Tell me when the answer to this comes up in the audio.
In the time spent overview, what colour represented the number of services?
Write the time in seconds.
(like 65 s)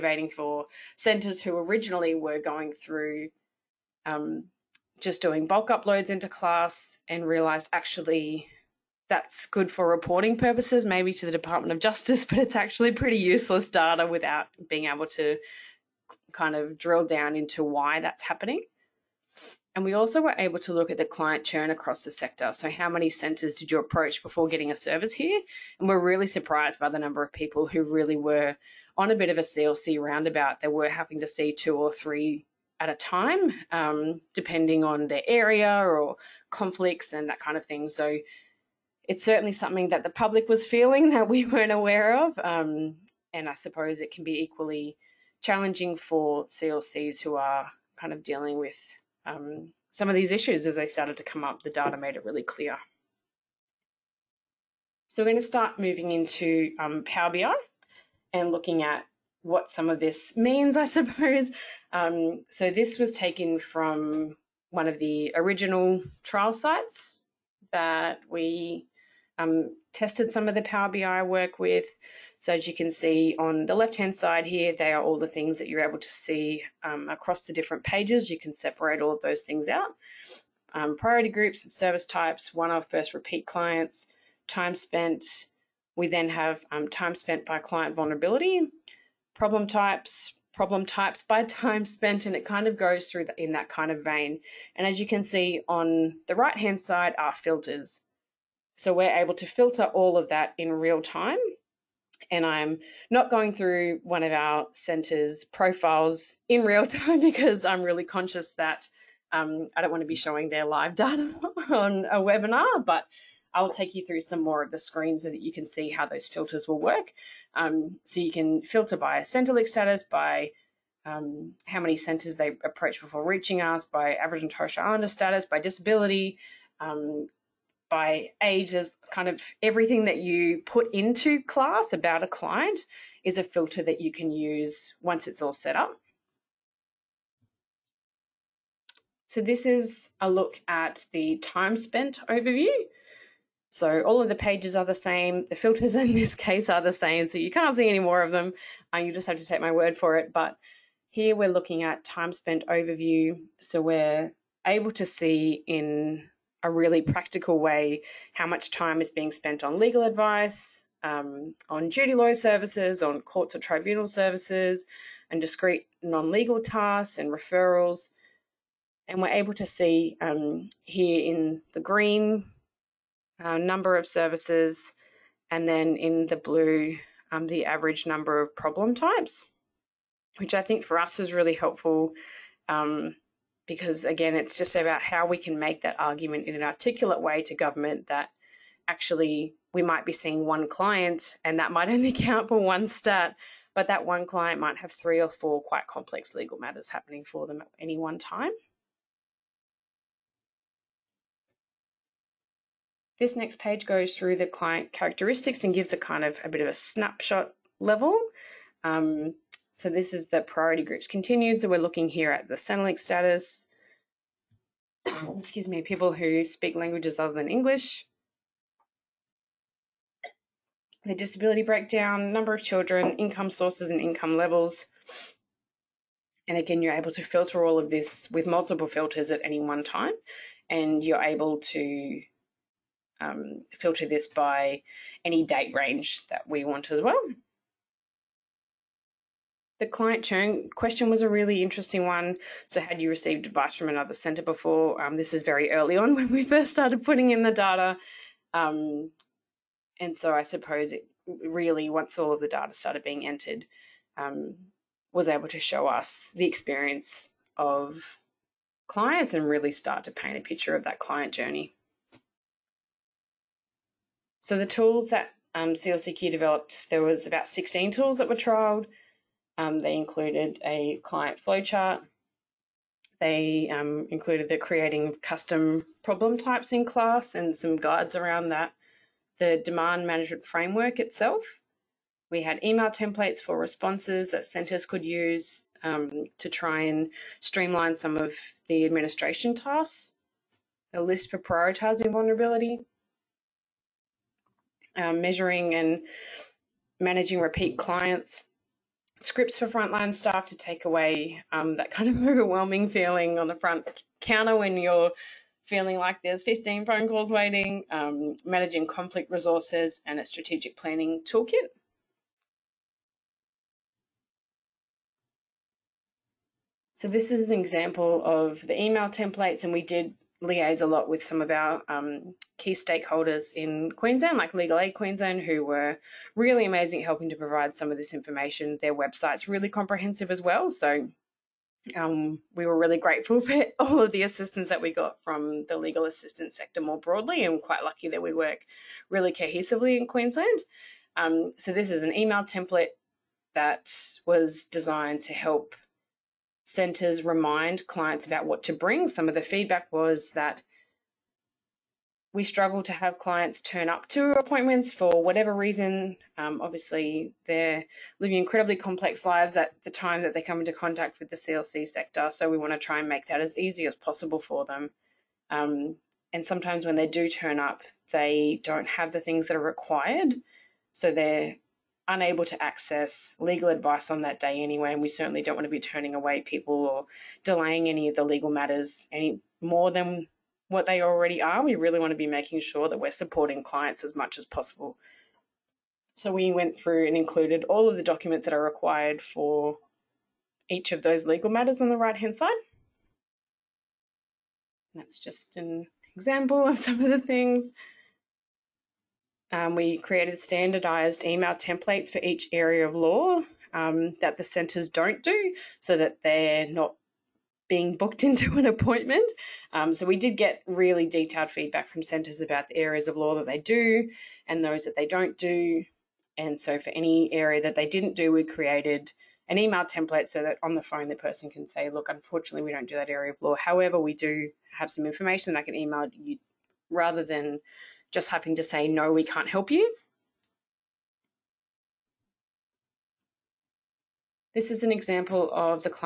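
171 s.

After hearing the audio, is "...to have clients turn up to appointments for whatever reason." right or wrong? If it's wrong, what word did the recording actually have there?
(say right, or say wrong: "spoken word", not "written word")
right.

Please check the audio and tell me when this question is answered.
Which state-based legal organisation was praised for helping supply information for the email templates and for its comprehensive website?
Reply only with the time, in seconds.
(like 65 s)
324 s.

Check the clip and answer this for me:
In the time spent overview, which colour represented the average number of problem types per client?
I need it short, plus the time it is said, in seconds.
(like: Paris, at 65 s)
blue, at 176 s.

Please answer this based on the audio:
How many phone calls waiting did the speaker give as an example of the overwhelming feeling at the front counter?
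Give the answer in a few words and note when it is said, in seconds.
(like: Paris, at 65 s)
15, at 306 s.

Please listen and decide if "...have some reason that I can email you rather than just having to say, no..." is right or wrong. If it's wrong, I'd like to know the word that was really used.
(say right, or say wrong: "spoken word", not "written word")
wrong: "information", not "reason".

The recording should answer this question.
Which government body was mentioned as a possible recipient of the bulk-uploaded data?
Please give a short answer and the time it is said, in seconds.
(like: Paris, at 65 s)
Department of Justice, at 11 s.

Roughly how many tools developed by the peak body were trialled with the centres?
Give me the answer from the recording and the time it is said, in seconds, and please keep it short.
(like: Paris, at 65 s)
16, at 267 s.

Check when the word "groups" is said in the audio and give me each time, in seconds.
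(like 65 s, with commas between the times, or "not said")
81 s, 210 s.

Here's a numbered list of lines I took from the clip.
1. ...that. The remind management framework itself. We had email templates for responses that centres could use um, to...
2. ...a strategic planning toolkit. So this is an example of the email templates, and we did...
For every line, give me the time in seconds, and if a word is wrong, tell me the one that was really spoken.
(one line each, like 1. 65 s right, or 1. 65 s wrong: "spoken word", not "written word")
1. 278 s wrong: "demand", not "remind"
2. 310 s right.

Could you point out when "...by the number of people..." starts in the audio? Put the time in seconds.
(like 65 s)
26 s.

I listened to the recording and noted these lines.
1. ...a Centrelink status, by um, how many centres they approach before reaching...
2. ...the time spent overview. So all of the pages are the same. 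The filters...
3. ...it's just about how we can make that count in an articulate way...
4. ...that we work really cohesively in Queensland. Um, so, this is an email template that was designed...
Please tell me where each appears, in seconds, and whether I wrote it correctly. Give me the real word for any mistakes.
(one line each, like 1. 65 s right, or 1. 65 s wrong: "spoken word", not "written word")
1. 119 s right
2. 141 s right
3. 184 s wrong: "argument", not "count"
4. 338 s right.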